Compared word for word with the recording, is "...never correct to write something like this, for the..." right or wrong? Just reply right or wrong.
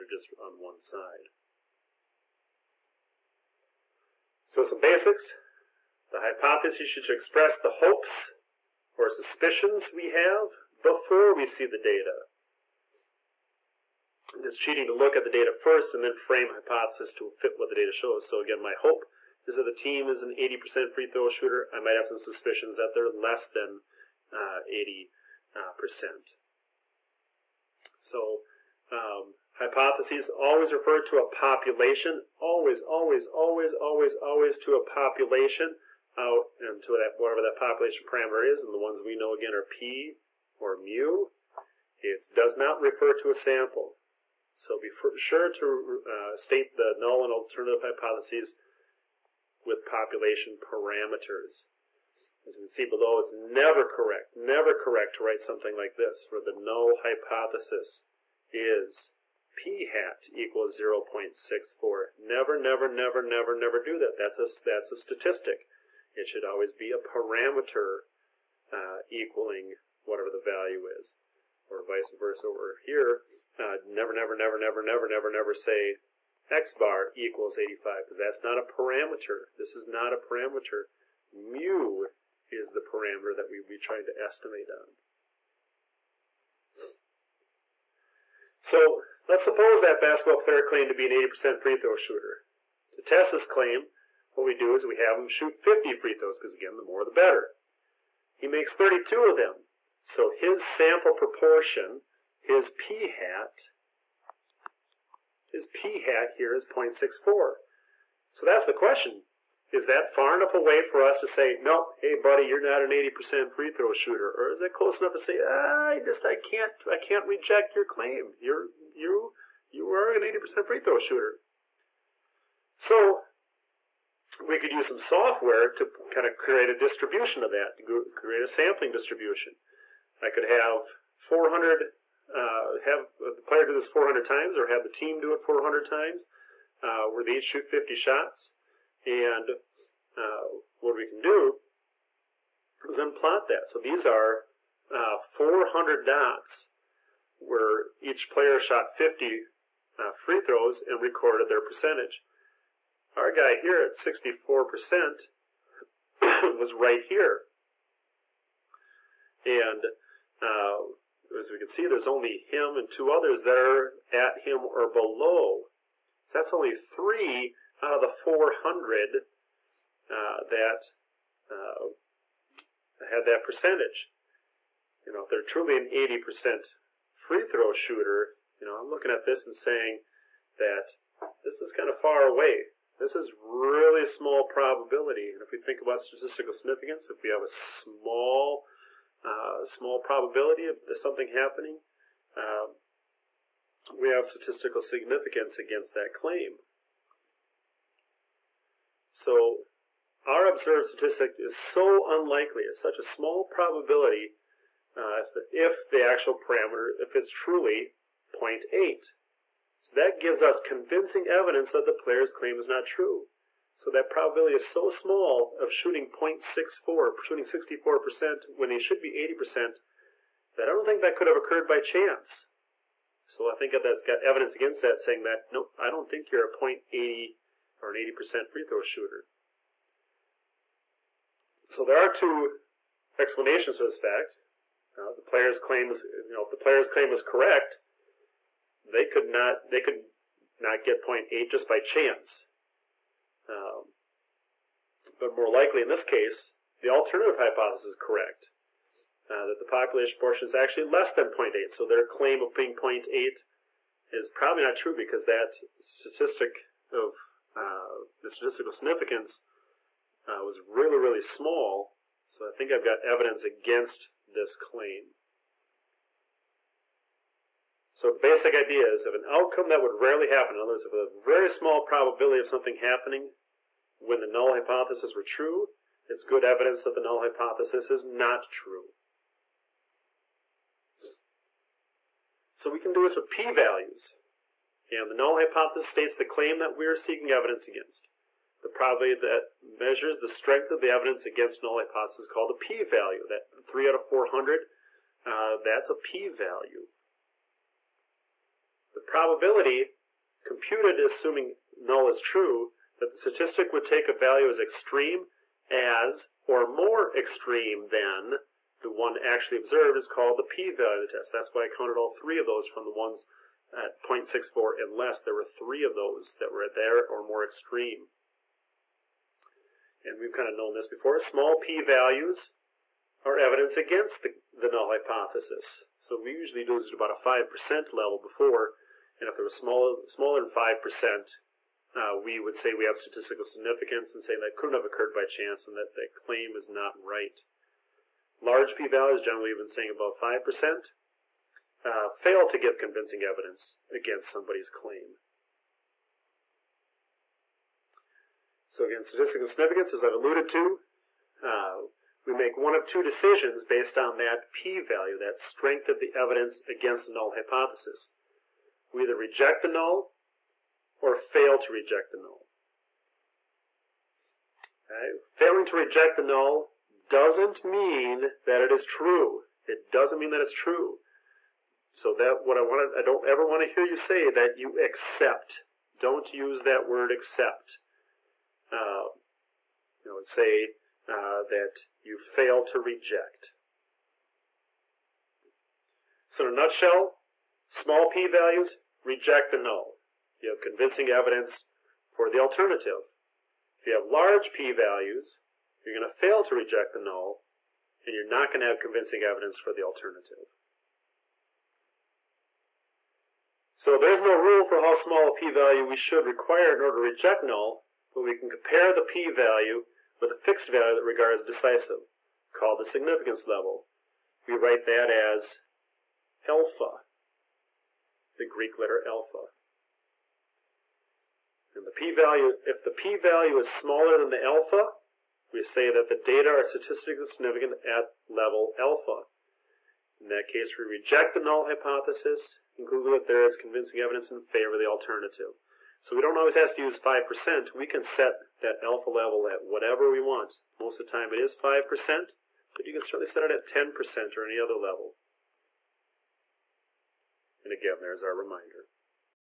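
right.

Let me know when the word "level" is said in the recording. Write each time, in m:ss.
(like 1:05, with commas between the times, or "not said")
5:27, 6:53, 7:08, 7:19, 7:24.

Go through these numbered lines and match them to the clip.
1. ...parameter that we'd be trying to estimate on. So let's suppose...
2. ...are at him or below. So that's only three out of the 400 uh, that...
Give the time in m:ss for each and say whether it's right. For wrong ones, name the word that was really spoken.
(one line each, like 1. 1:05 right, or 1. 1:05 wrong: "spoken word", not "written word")
1. 1:22 right
2. 2:43 right.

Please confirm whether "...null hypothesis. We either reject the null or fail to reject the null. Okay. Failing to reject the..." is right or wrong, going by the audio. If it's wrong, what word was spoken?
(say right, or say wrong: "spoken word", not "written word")
right.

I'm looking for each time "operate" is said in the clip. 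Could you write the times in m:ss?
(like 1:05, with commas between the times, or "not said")
not said.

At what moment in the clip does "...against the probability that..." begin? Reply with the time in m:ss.
4:47.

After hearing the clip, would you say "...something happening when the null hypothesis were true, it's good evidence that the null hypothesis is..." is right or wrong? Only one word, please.
right.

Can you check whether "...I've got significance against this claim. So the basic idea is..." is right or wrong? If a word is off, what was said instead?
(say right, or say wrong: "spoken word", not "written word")
wrong: "evidence", not "significance".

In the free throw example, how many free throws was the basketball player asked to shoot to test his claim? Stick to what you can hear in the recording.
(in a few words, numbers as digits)
50.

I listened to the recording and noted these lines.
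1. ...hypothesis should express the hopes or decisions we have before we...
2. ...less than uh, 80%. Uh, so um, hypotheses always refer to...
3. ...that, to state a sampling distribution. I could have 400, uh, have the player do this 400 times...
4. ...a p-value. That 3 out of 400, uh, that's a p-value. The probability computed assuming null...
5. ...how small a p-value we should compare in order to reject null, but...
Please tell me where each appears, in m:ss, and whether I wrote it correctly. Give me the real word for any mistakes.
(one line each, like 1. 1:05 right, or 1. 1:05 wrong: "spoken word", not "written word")
1. 0:06 wrong: "suspicions", not "decisions"
2. 0:23 right
3. 2:07 wrong: "create", not "state"
4. 4:52 right
5. 6:44 wrong: "require", not "compare".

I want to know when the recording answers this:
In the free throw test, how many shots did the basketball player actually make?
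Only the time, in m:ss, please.
1:38.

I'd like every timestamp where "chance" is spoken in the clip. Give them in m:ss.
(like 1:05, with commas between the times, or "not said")
3:41, 4:01, 5:35.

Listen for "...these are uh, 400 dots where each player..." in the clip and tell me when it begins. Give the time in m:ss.
2:23.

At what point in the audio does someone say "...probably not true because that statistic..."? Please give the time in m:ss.
4:14.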